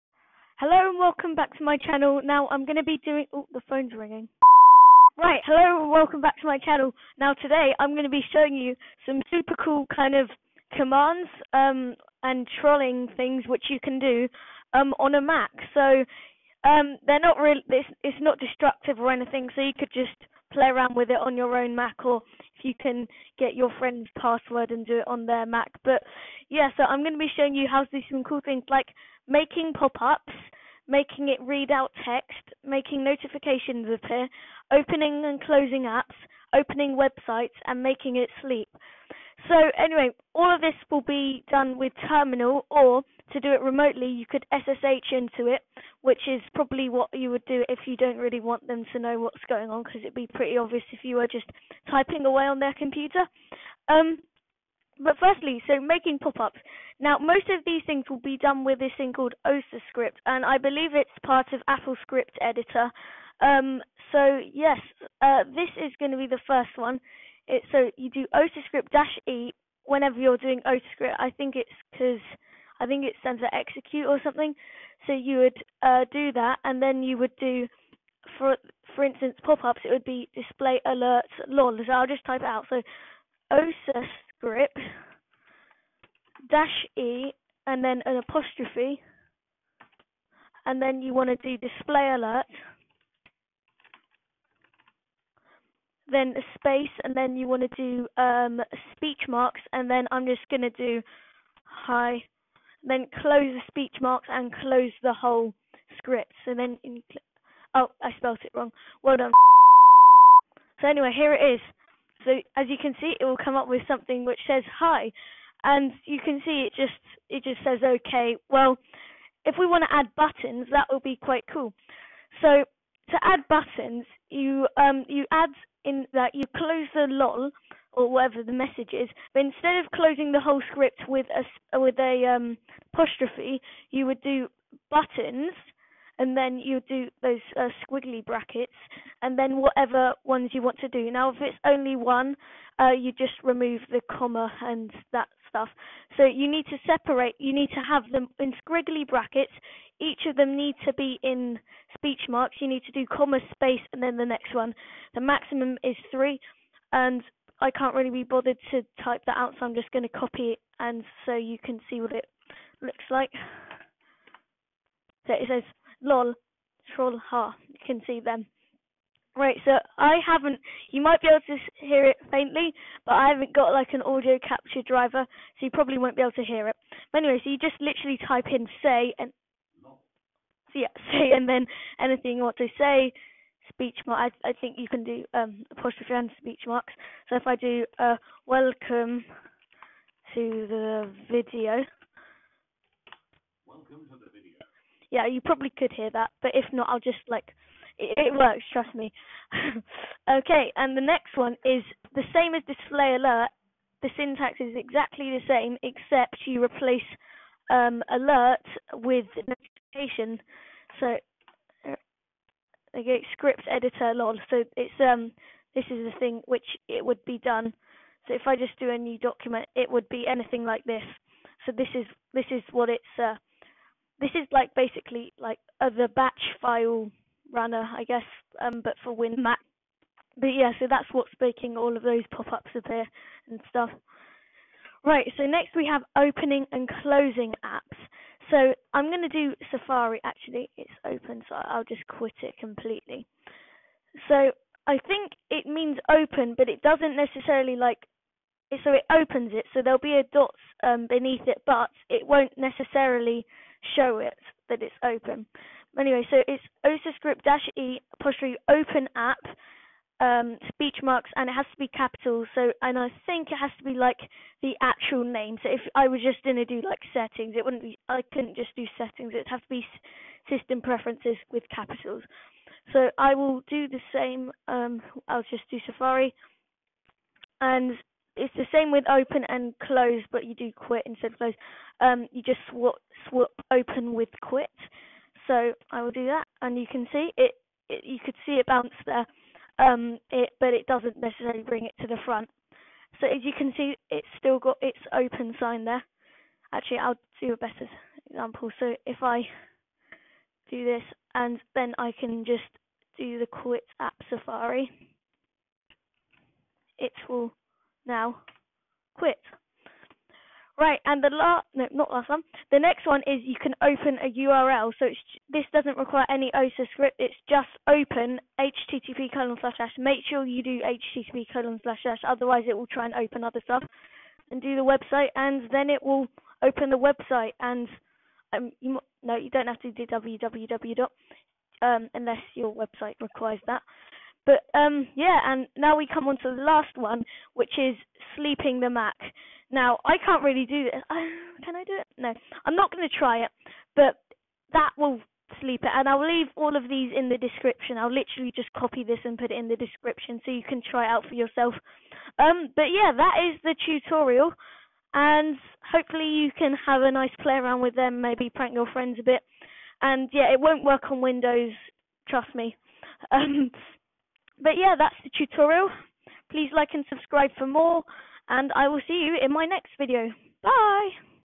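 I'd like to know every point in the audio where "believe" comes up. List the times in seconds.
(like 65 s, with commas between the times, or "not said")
60 s.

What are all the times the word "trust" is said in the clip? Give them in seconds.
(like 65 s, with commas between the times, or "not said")
198 s, 362 s.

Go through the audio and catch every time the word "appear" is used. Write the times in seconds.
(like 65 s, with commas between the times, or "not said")
33 s, 232 s.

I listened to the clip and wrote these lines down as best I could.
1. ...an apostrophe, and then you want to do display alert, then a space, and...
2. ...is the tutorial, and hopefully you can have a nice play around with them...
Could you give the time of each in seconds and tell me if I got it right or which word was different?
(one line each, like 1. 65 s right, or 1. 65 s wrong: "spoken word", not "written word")
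1. 88 s right
2. 353 s right.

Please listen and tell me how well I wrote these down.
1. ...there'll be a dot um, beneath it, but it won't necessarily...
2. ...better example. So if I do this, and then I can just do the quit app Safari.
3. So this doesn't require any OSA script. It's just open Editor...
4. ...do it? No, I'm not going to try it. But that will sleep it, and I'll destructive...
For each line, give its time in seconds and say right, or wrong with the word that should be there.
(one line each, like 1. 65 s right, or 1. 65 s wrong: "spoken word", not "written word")
1. 249 s right
2. 297 s right
3. 314 s wrong: "HTTP", not "Editor"
4. 341 s wrong: "leave", not "destructive".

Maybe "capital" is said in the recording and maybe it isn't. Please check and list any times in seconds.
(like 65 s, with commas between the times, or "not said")
261 s, 271 s.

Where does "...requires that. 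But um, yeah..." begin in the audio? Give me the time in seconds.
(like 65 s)
333 s.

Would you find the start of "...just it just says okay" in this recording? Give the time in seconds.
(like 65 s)
116 s.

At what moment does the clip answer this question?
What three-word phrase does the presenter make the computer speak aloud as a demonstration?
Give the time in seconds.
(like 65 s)
188 s.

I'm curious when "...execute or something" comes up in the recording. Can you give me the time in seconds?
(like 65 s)
73 s.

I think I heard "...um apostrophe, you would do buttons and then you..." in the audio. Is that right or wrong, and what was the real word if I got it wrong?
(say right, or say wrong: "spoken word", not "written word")
right.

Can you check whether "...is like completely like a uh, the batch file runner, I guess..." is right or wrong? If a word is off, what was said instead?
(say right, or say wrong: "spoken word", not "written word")
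wrong: "basically", not "completely".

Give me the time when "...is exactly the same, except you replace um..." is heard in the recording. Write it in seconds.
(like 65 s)
204 s.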